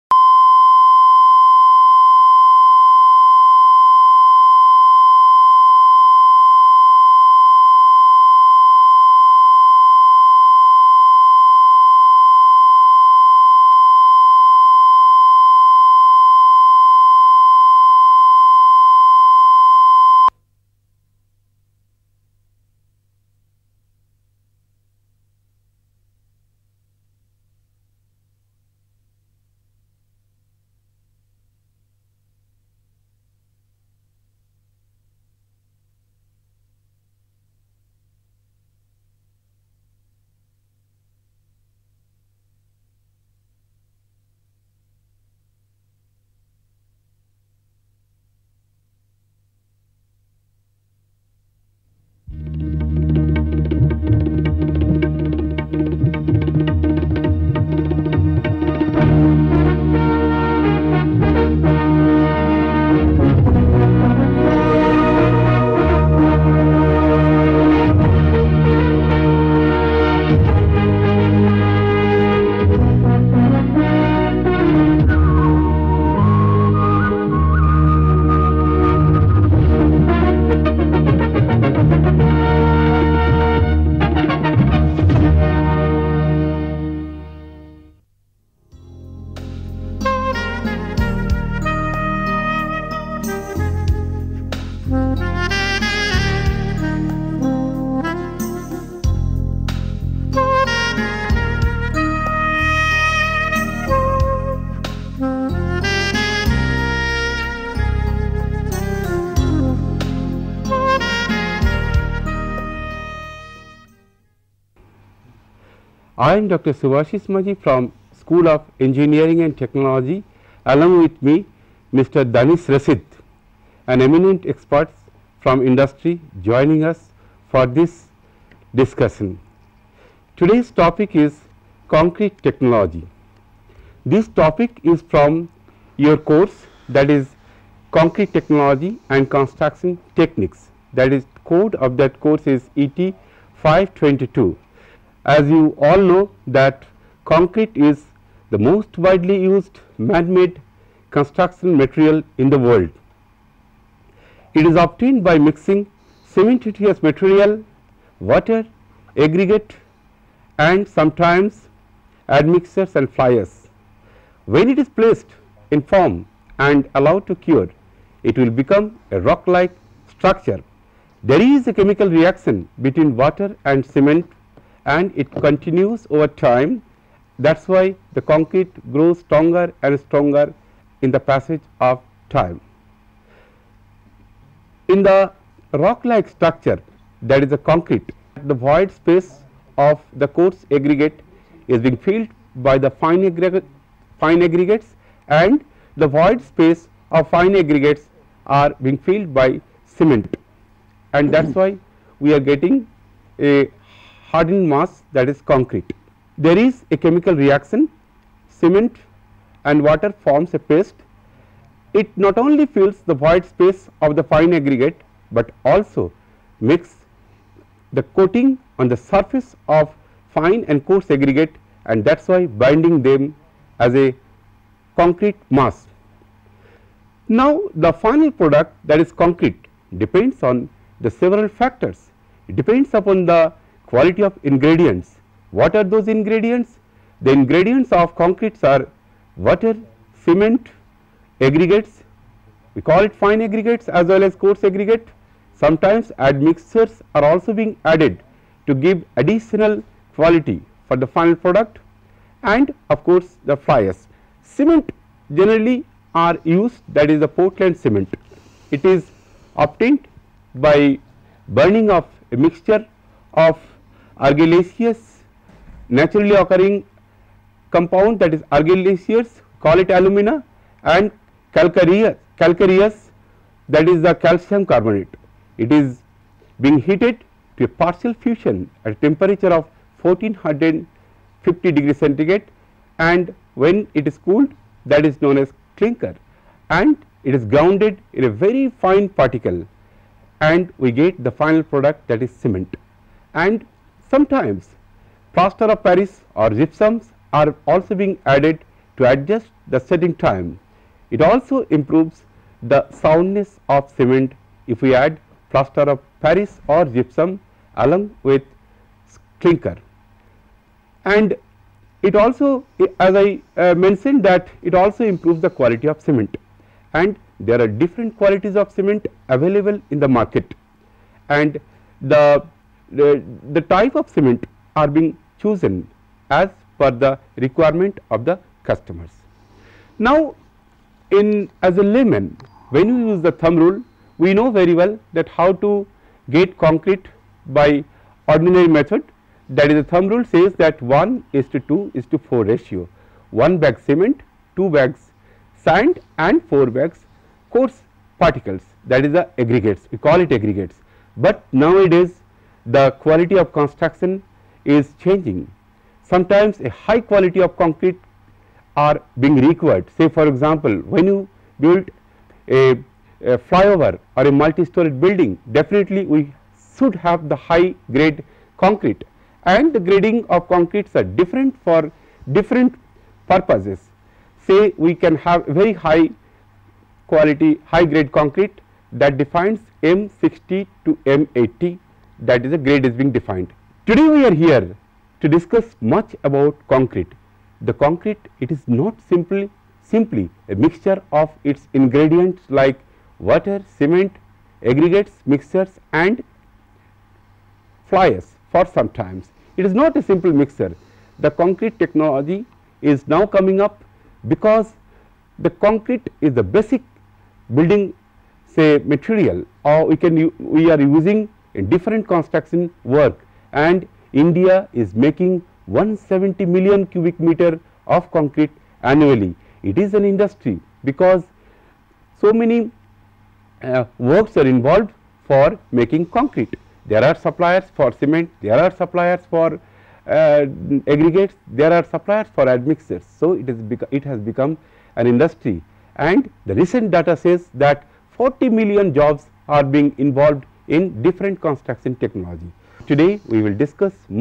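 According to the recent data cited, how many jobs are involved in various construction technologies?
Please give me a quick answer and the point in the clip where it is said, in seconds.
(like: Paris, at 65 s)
40 million, at 438 s.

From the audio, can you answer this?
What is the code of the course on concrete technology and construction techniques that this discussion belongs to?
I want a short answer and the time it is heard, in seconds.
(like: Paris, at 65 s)
ET 522, at 142 s.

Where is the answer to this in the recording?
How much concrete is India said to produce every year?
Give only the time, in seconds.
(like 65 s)
415 s.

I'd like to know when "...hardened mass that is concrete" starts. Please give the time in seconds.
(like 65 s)
204 s.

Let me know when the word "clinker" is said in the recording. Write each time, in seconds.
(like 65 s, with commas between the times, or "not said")
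285 s, 309 s.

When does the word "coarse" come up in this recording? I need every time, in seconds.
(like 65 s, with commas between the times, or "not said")
190 s, 220 s, 244 s, 347 s.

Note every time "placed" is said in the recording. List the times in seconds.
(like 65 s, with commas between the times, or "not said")
164 s.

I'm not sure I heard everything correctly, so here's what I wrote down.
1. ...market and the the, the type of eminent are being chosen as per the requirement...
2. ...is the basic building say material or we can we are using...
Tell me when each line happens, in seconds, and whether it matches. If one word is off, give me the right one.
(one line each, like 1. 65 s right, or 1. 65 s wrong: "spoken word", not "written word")
1. 320 s wrong: "cement", not "eminent"
2. 406 s right.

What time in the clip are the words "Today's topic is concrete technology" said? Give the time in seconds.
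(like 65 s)
130 s.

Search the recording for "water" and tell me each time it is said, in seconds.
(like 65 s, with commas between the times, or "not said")
158 s, 173 s, 209 s, 239 s, 393 s.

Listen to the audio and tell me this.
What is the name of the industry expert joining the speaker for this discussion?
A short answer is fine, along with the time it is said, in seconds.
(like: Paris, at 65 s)
Danish Rasid, at 122 s.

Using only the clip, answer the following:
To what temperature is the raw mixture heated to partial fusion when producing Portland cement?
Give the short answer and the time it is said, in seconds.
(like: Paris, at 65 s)
1450 degrees centigrade, at 280 s.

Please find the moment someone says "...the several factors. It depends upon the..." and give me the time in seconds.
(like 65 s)
231 s.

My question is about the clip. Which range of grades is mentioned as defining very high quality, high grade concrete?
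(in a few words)
M 60 to M 80.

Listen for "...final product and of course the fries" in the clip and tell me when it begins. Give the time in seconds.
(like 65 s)
251 s.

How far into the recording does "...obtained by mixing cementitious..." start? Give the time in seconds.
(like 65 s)
154 s.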